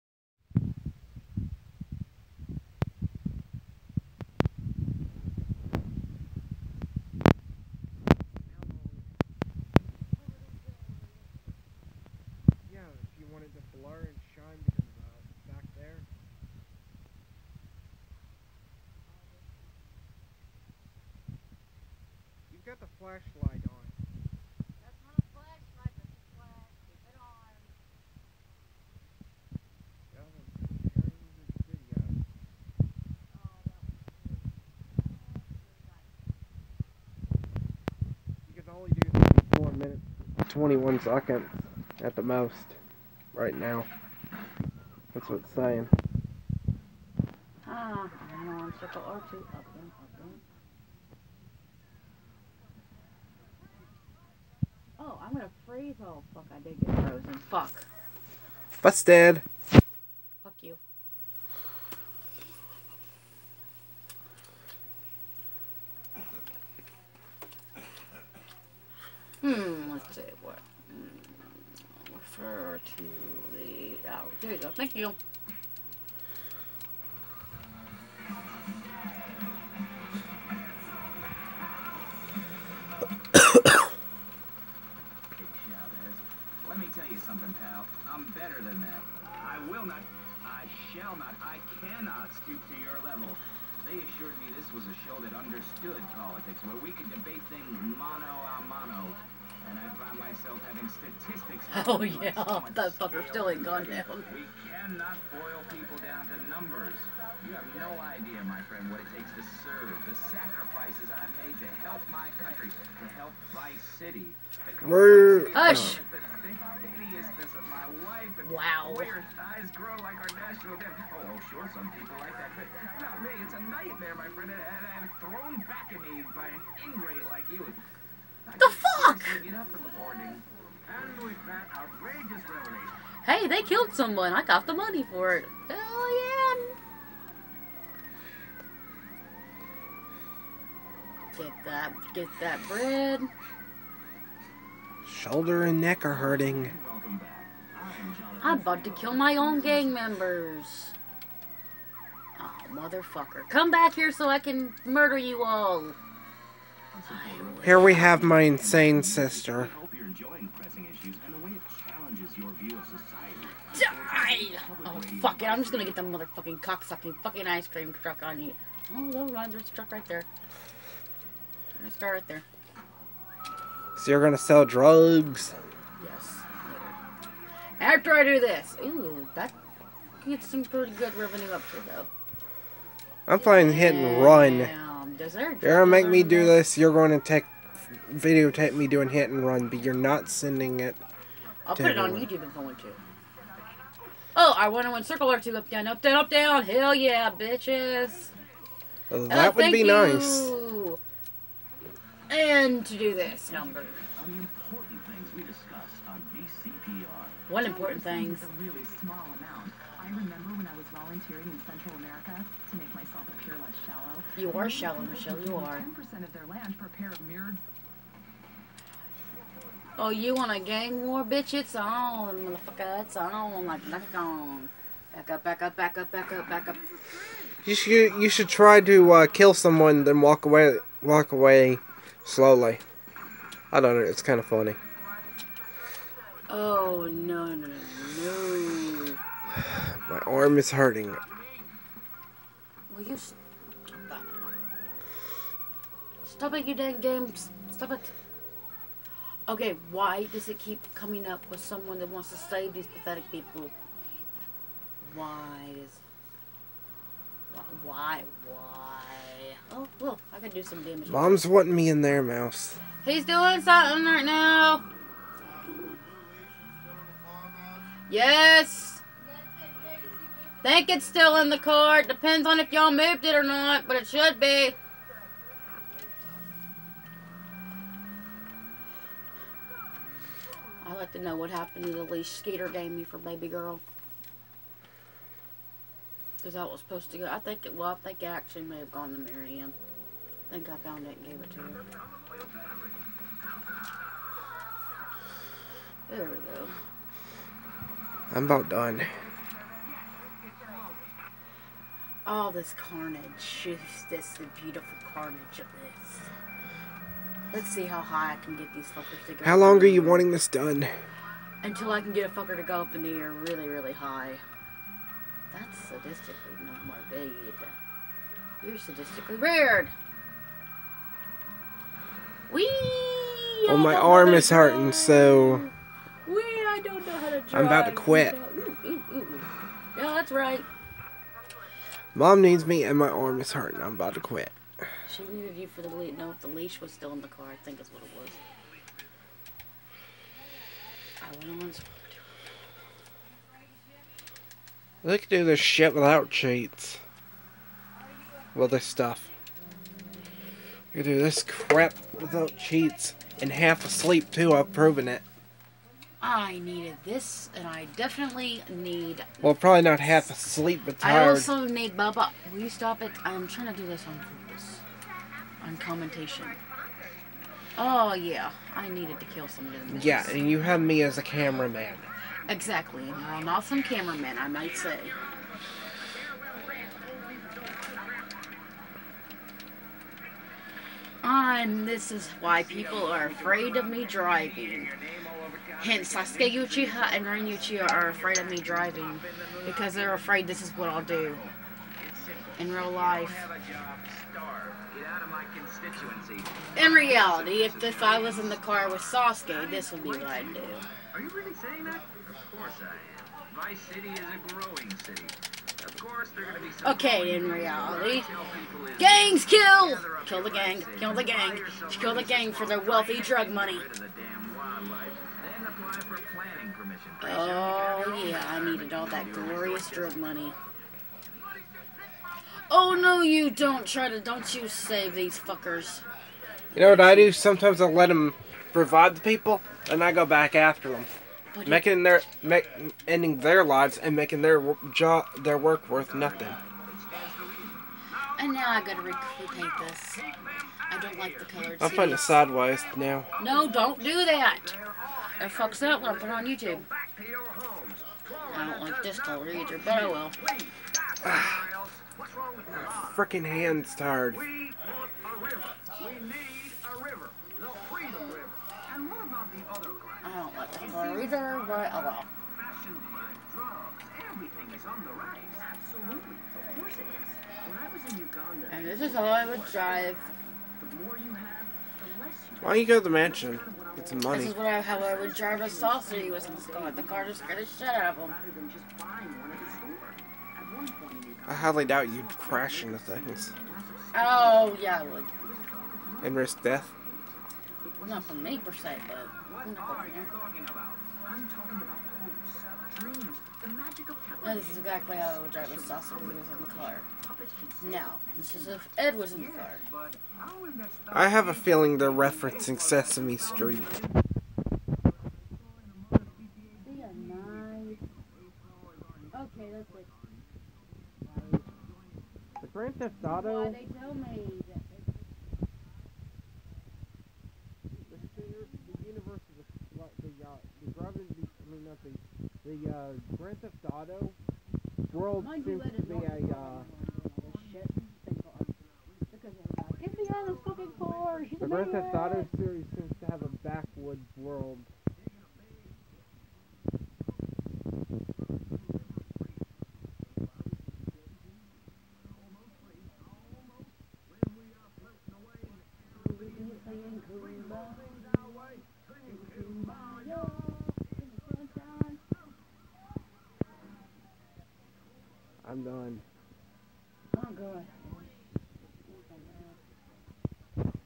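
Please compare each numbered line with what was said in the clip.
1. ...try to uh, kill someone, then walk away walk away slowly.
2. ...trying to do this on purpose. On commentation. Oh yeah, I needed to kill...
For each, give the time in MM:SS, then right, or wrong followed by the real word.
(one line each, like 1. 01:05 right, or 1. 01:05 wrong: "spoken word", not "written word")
1. 03:48 right
2. 06:03 right.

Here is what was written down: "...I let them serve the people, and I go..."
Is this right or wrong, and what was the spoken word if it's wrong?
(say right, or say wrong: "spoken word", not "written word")
wrong: "revive", not "serve".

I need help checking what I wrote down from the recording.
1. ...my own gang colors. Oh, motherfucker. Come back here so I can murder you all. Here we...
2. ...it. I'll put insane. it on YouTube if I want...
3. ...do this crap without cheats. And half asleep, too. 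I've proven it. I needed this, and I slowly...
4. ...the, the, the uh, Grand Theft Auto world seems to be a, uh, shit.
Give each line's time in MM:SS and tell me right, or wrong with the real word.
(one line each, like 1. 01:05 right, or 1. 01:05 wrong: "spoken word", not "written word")
1. 02:29 wrong: "members", not "colors"
2. 03:10 wrong: "everyone", not "insane"
3. 05:51 wrong: "definitely", not "slowly"
4. 08:41 right.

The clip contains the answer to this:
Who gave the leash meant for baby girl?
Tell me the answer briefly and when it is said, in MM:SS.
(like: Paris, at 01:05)
Skeeter, at 04:42.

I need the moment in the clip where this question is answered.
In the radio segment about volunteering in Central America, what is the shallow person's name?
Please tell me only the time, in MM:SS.
03:34.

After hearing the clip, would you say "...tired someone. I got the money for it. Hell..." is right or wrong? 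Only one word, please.
wrong.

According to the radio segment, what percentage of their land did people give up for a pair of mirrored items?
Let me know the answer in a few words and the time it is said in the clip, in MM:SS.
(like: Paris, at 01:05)
10%, at 03:35.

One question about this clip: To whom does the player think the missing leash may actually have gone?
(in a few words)
Marianne.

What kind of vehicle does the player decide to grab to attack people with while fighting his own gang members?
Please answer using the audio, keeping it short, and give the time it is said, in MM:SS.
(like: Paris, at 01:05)
ice cream truck, at 02:47.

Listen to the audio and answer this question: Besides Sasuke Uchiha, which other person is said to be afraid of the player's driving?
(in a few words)
Rin Uchiha.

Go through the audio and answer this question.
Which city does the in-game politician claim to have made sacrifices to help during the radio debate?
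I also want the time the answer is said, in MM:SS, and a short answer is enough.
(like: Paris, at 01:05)
Vice City, at 01:53.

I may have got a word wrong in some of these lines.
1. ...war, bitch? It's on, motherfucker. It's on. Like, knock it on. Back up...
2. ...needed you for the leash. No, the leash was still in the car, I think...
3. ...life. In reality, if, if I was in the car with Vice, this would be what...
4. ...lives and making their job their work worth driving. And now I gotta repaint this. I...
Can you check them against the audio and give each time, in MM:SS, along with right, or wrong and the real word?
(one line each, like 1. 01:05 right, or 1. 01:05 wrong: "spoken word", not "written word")
1. 03:41 right
2. 05:35 right
3. 06:32 wrong: "Sasuke", not "Vice"
4. 07:13 wrong: "nothing", not "driving".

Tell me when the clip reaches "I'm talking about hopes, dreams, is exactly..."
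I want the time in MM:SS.
08:09.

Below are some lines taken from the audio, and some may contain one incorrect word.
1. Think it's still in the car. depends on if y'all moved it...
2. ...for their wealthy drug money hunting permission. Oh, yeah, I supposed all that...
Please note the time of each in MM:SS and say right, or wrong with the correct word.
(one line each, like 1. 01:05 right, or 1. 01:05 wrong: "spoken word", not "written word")
1. 04:30 right
2. 06:52 wrong: "needed", not "supposed".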